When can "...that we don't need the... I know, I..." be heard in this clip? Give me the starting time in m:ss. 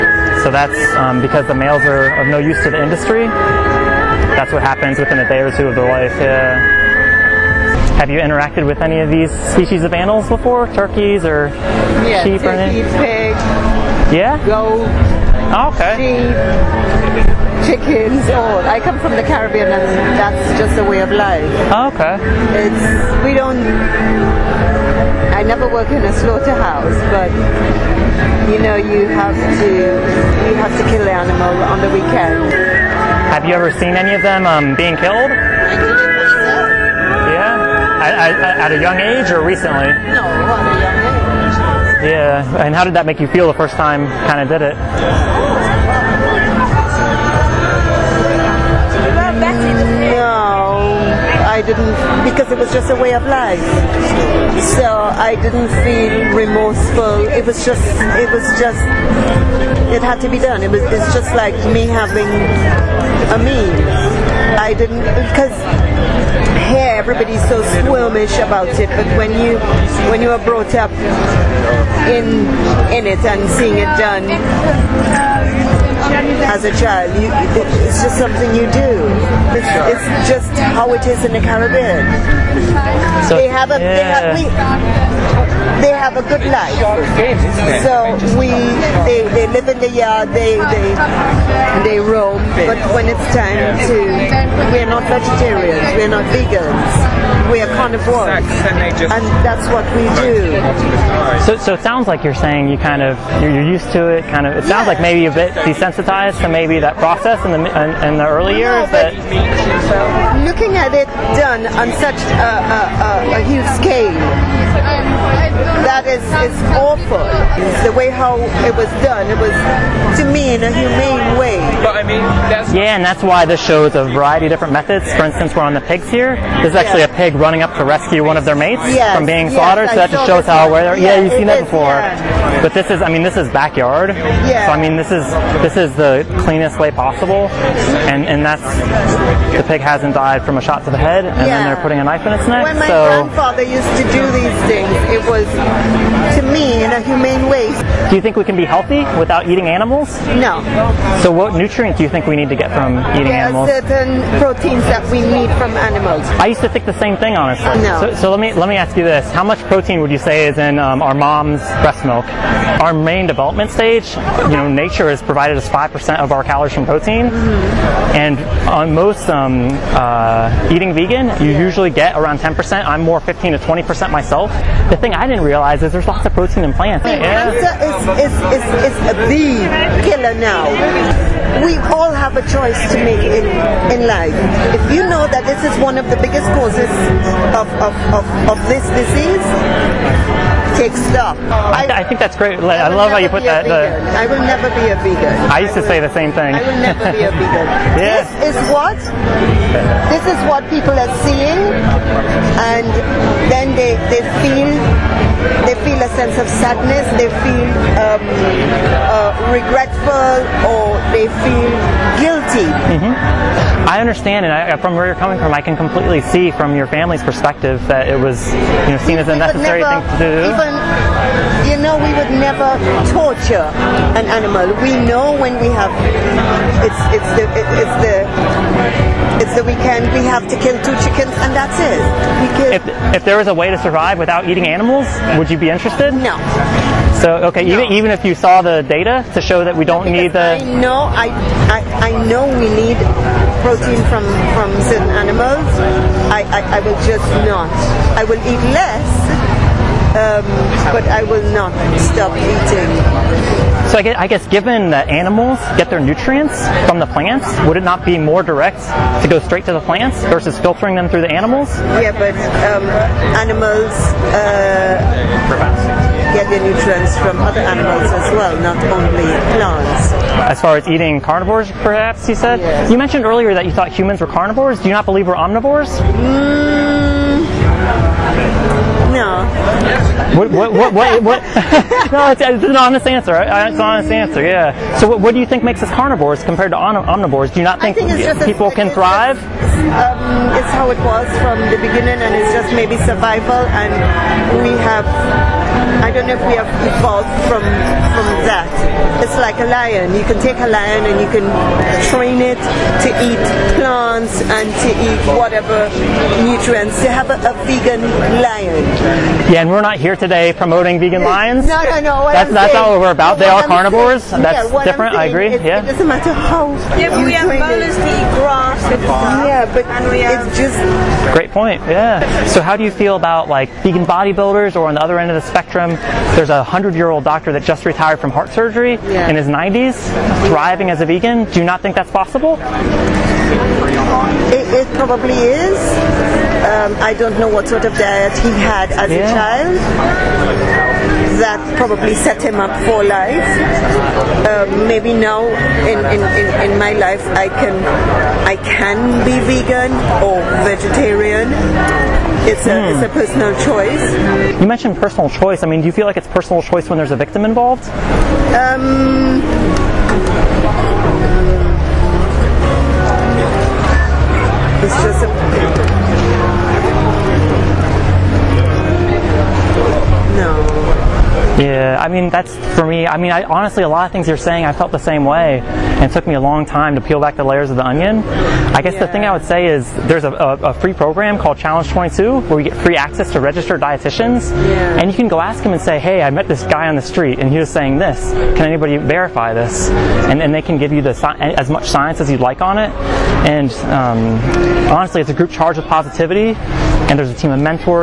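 3:59.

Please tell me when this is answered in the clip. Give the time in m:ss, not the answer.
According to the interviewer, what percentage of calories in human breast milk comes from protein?
2:45.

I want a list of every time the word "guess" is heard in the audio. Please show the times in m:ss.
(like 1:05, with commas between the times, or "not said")
4:14, 6:18.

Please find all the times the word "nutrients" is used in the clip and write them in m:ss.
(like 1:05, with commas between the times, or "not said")
2:31, 4:16, 4:26, 5:06.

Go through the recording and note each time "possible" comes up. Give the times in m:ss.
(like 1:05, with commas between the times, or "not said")
2:16, 5:32.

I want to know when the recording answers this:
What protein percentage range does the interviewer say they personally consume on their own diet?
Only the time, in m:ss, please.
2:53.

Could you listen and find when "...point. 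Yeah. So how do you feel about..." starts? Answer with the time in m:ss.
5:21.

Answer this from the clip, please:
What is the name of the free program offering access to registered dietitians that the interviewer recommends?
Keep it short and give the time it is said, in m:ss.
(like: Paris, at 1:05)
Challenge 22, at 6:21.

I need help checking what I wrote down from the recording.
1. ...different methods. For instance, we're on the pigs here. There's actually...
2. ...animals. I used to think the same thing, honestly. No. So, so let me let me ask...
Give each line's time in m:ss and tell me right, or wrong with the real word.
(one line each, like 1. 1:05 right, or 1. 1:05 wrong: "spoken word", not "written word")
1. 2:04 right
2. 2:35 right.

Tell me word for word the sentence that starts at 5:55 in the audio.
I mean, do you feel like it's personal choice when there's a victim involved?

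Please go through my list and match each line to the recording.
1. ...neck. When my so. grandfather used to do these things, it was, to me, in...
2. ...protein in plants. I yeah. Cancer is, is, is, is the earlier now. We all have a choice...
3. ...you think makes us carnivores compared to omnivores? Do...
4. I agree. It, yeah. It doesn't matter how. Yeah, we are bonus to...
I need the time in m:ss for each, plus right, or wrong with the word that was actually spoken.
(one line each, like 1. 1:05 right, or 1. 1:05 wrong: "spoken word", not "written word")
1. 2:22 right
2. 2:56 wrong: "killer", not "earlier"
3. 4:45 right
4. 5:15 right.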